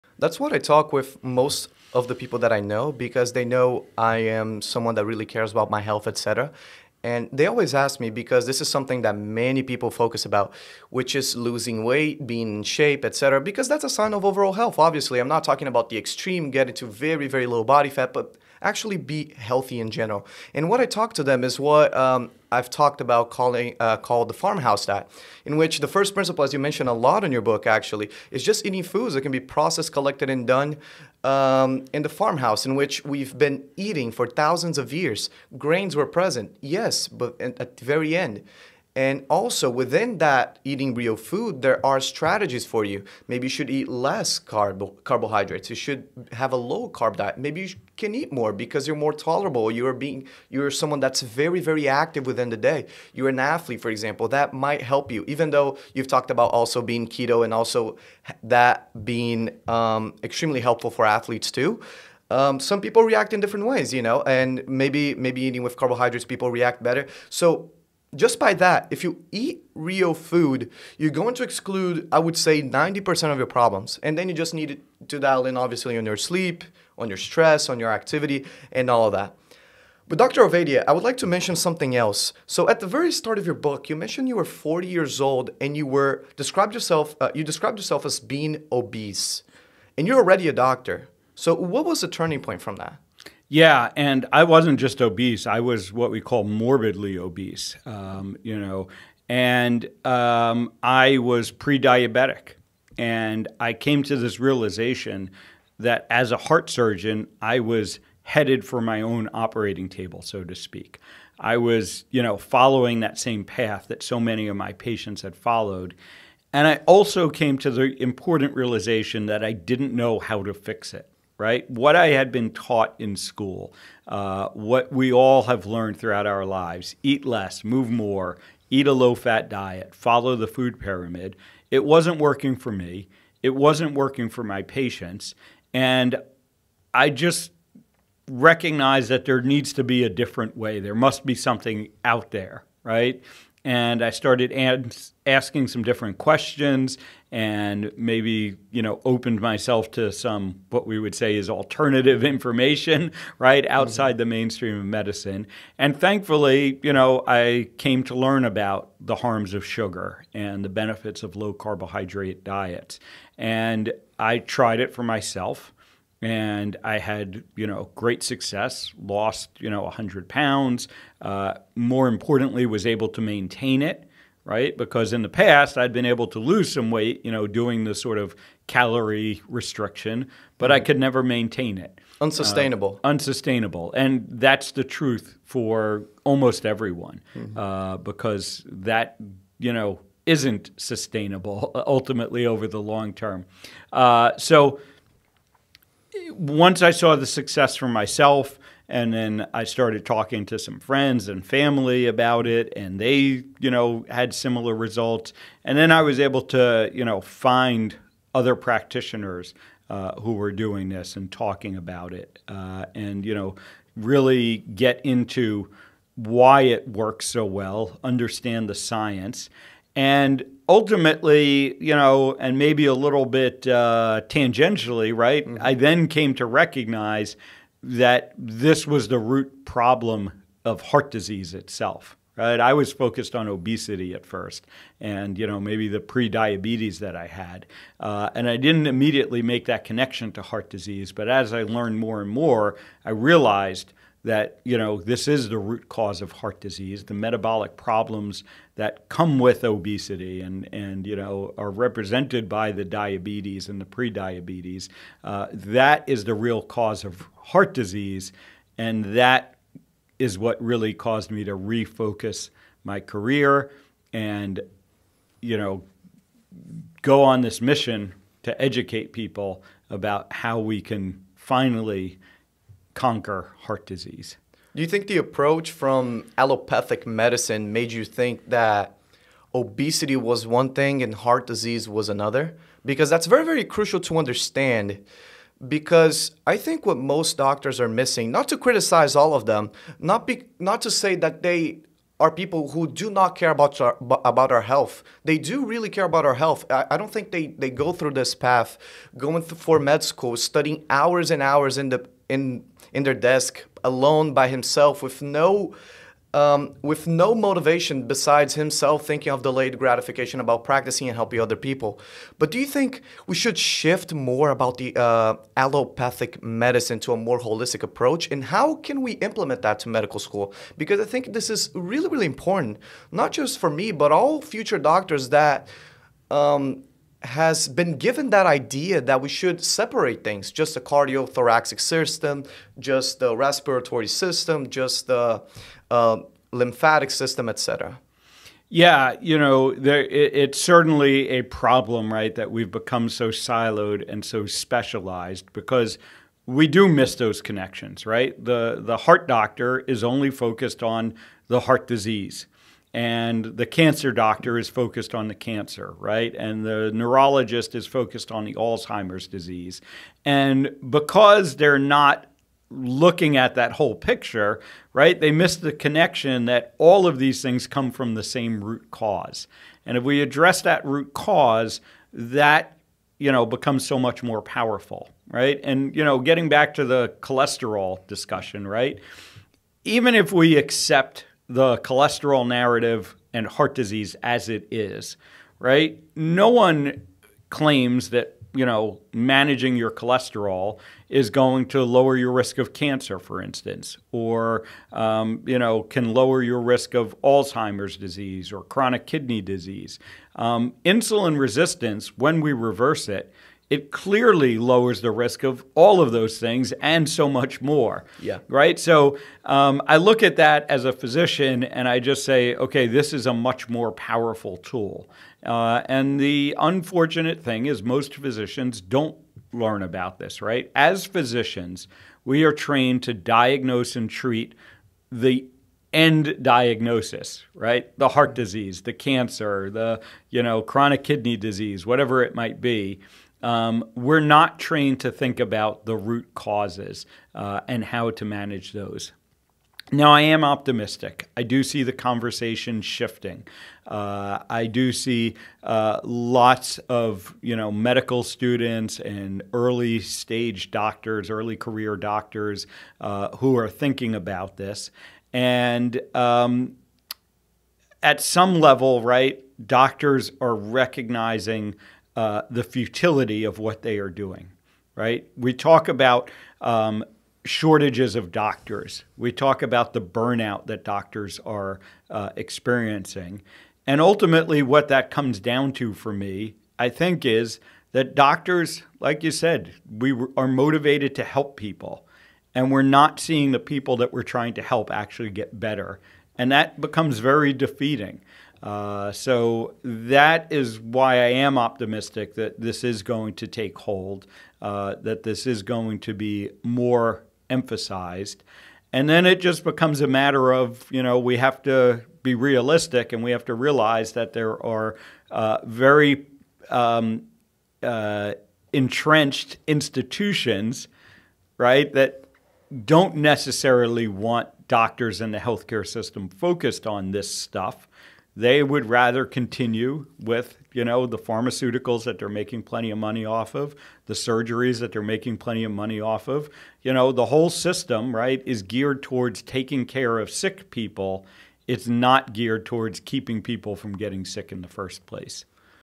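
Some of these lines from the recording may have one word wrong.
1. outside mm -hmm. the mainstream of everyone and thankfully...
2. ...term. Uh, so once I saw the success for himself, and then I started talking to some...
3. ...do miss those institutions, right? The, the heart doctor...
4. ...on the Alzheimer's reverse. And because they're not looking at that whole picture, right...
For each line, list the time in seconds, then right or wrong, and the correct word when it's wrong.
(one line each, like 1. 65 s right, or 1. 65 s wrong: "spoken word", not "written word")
1. 153 s wrong: "medicine", not "everyone"
2. 193 s wrong: "myself", not "himself"
3. 346 s wrong: "connections", not "institutions"
4. 358 s wrong: "disease", not "reverse".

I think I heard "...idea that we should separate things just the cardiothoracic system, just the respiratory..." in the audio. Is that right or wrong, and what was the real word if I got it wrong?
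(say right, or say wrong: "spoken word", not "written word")
right.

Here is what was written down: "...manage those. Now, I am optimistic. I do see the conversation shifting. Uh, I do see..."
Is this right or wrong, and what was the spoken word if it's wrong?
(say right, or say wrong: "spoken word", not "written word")
right.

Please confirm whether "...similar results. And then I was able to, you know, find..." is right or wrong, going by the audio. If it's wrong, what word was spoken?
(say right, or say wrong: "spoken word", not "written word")
right.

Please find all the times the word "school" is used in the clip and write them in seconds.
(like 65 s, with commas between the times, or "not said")
123 s, 300 s, 320 s.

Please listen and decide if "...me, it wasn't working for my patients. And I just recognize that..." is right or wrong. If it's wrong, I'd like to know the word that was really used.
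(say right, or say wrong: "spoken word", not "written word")
right.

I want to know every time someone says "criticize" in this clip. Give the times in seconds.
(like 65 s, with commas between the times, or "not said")
288 s.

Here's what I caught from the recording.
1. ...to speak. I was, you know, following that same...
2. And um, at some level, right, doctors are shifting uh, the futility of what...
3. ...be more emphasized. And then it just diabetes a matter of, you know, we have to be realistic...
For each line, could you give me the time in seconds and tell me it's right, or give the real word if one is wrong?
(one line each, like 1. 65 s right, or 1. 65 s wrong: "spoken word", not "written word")
1. 110 s right
2. 455 s wrong: "recognizing", not "shifting"
3. 496 s wrong: "becomes", not "diabetes".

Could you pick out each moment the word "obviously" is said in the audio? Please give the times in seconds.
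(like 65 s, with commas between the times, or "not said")
14 s, 75 s.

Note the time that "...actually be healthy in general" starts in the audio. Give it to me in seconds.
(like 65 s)
18 s.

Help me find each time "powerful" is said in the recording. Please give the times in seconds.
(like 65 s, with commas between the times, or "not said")
374 s, 413 s.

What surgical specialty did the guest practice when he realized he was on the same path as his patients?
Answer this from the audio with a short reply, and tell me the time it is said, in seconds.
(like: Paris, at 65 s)
heart surgeon, at 106 s.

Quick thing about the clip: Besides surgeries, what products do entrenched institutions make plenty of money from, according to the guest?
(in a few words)
pharmaceuticals.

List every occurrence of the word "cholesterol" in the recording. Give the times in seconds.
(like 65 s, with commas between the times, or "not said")
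377 s, 381 s, 389 s.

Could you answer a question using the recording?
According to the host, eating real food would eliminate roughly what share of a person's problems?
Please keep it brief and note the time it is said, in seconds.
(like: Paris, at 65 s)
90%, at 72 s.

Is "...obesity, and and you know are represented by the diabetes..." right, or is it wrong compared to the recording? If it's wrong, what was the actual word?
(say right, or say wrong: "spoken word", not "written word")
right.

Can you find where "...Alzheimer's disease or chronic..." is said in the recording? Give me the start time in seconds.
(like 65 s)
397 s.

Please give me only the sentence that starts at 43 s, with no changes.
Maybe you should eat less carbohydrates.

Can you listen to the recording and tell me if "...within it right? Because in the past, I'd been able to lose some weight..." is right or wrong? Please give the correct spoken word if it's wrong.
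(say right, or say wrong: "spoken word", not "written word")
wrong: "maintain", not "within".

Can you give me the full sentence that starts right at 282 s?
Because that's very, very crucial to understand.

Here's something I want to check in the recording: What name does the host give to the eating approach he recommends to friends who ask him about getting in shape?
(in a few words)
farmhouse diet.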